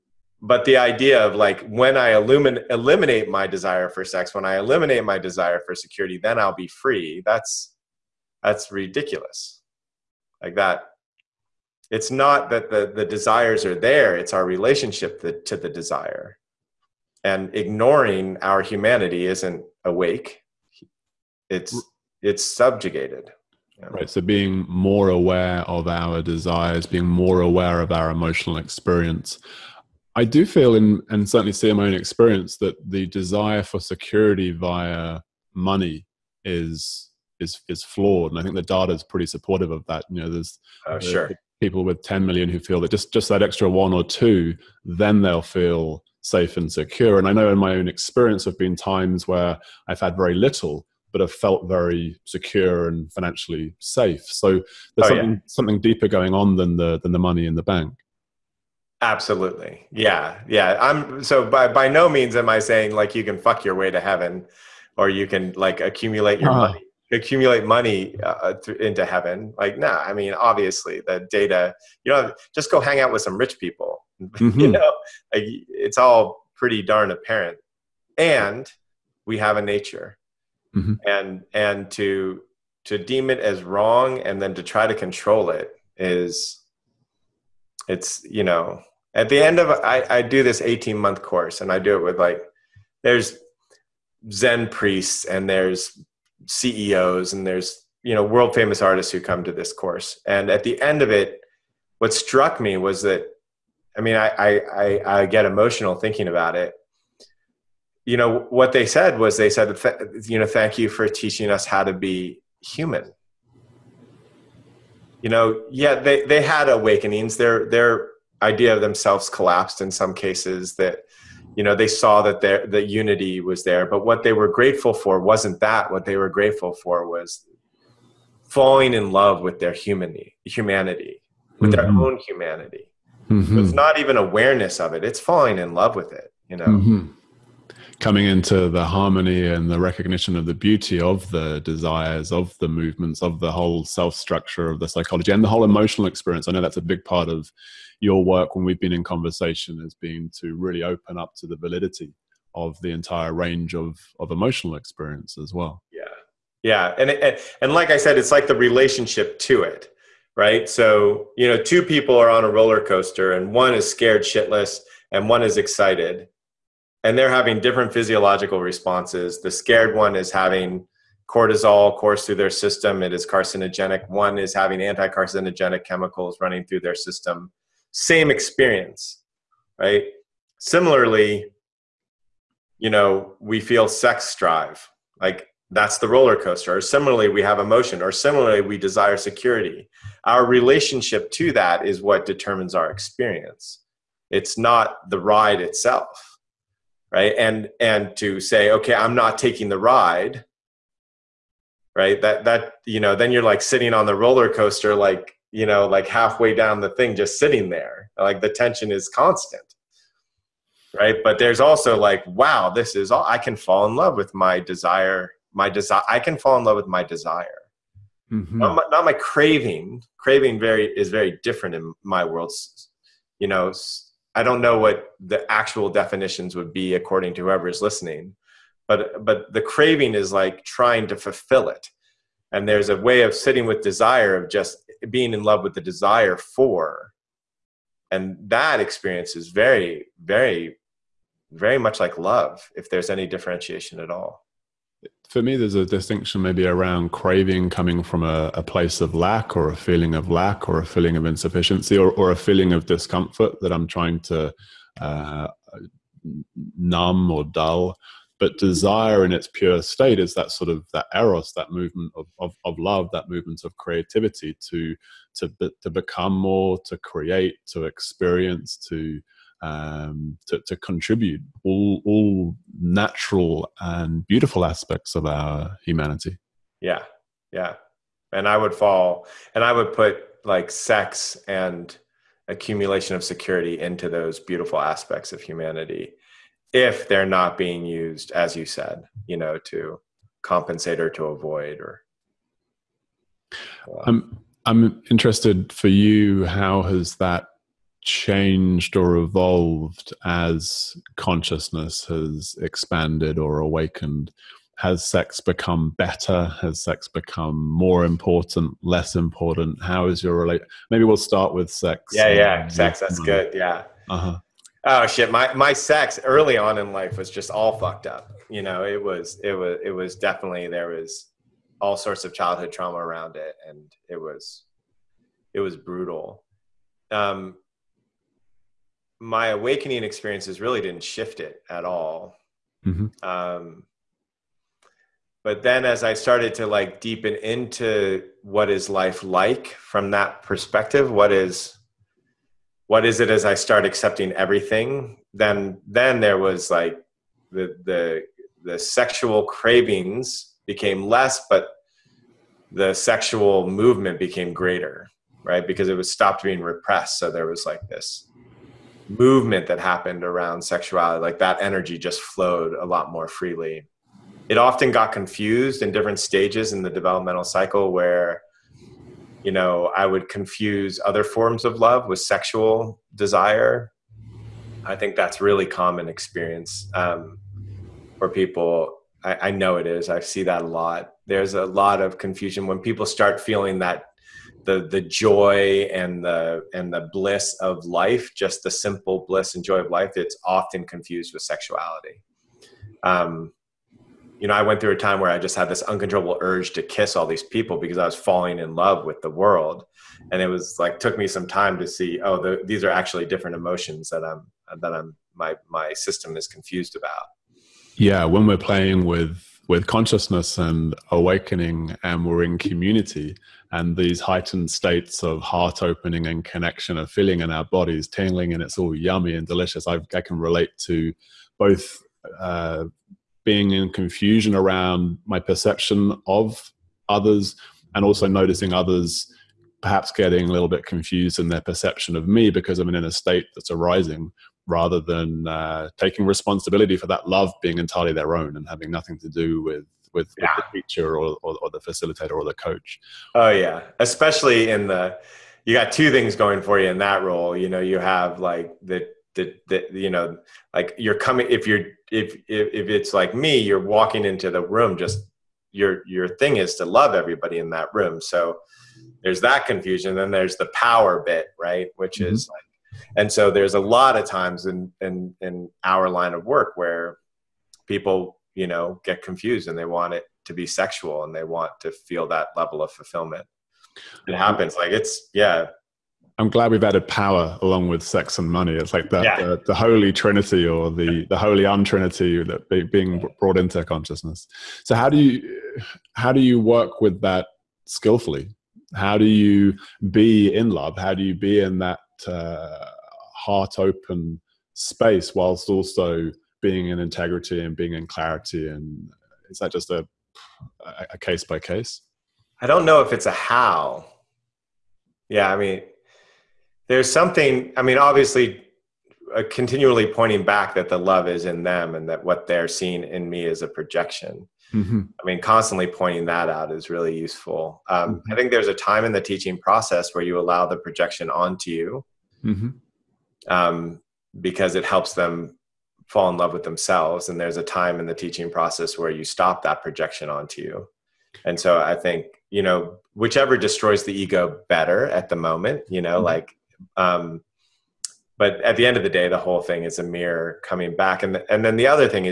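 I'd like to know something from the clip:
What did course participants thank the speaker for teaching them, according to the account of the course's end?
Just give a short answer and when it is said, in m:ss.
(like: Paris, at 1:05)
how to be human, at 1:51.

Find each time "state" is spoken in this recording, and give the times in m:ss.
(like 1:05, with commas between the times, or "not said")
4:19, 6:54, 7:13.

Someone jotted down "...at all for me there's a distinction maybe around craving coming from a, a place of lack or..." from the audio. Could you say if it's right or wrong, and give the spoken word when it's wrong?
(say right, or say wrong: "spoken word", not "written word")
right.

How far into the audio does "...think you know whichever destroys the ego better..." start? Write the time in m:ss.
8:51.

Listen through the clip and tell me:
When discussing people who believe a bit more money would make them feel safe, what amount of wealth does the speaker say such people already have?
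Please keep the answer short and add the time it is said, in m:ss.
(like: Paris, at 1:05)
10 million, at 0:42.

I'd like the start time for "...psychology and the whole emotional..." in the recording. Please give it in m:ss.
2:24.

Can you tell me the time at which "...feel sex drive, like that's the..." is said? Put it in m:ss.
3:03.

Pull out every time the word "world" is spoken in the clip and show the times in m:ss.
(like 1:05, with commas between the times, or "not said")
1:38, 3:42, 6:39.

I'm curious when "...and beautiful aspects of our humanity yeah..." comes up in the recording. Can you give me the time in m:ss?
4:33.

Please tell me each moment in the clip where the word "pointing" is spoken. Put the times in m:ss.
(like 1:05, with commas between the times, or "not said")
8:30, 8:35.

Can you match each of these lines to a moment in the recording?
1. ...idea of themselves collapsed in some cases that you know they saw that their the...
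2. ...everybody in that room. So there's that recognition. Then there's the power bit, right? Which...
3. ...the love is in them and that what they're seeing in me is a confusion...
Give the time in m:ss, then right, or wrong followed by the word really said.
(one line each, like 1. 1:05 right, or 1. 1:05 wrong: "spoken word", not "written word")
1. 1:58 right
2. 7:37 wrong: "confusion", not "recognition"
3. 8:30 wrong: "projection", not "confusion".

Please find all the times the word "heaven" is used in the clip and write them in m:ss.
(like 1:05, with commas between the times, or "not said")
1:04, 1:09.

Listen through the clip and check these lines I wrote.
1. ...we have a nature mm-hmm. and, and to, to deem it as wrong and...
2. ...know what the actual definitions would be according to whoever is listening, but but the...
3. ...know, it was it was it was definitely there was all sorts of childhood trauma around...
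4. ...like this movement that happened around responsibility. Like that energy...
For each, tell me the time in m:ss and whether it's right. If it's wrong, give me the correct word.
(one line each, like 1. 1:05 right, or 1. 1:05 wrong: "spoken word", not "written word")
1. 1:19 right
2. 3:44 right
3. 5:18 right
4. 5:57 wrong: "sexuality", not "responsibility".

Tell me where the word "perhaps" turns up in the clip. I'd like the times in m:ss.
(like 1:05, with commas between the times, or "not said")
7:09.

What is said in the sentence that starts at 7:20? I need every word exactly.
with the teacher or, or, or the facilitator or the coach.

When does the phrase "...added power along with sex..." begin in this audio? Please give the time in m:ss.
7:56.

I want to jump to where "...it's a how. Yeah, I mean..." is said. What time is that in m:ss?
8:23.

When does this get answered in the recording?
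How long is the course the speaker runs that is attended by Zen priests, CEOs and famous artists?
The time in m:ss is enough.
1:30.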